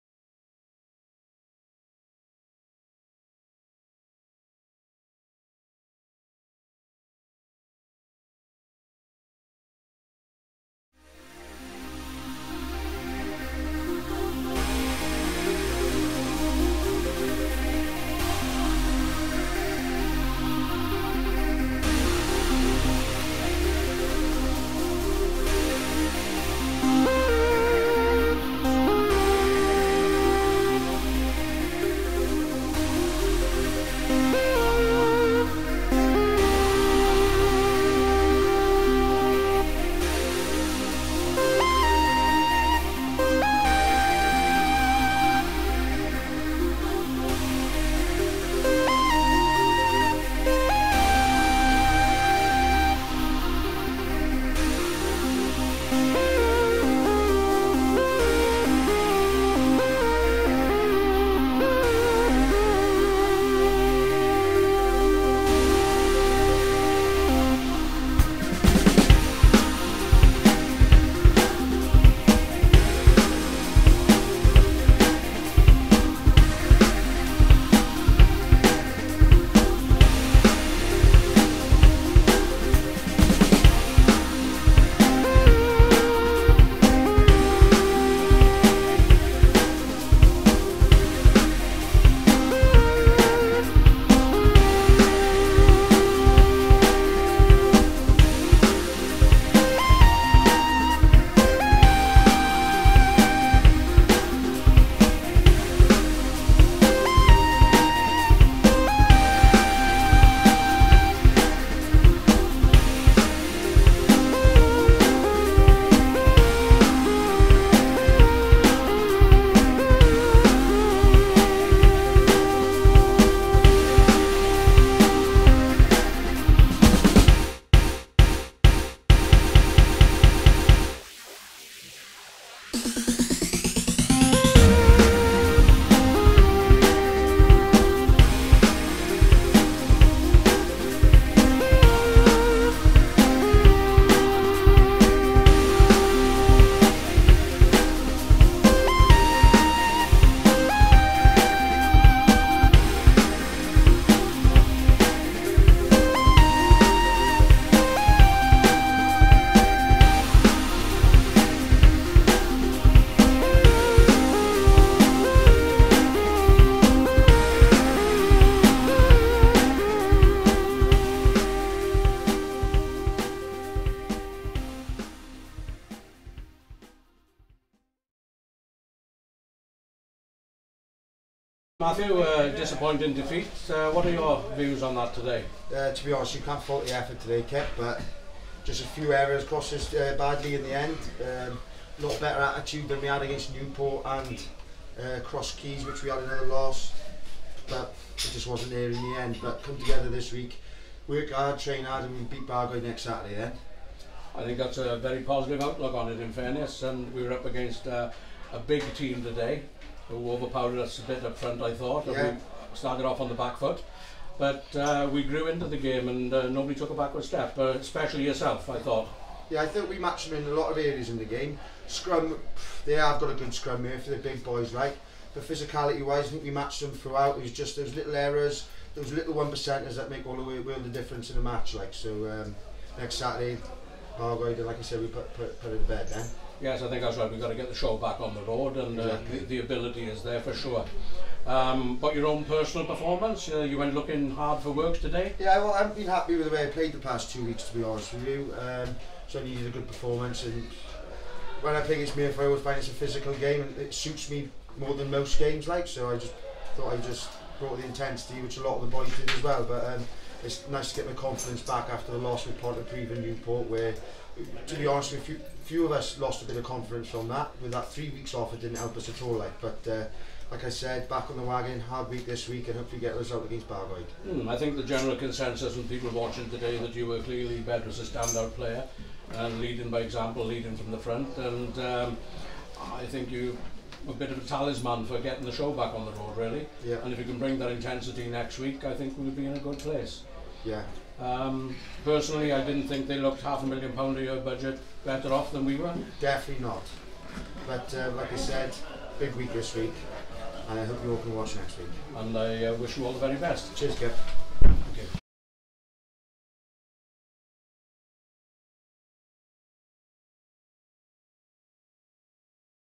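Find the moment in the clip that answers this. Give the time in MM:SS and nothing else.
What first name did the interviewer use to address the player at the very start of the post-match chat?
03:01.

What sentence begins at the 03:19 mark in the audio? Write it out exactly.
But come together this week, work hard, train hard, and we beat Bargoed next Saturday then.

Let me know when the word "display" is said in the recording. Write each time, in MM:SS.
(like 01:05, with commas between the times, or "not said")
not said.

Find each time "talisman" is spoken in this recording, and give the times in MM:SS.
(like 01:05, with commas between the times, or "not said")
04:44.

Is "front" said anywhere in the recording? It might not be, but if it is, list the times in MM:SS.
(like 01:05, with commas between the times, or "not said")
03:31, 04:40.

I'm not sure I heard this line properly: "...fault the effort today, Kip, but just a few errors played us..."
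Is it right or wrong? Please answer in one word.
wrong.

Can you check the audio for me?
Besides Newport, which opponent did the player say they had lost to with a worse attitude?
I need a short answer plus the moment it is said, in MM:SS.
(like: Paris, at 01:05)
Cross Keys, at 03:15.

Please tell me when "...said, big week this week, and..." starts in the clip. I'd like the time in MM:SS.
04:58.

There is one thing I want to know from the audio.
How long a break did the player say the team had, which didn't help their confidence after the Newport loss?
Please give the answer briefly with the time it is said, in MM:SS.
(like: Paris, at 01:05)
3 weeks, at 04:27.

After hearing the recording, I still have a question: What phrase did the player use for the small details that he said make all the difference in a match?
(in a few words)
one percenters.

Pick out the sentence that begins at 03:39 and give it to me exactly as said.
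Yeah, I think we matched them in a lot of areas in the game.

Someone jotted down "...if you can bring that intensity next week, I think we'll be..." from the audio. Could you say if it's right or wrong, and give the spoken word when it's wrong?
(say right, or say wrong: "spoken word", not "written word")
right.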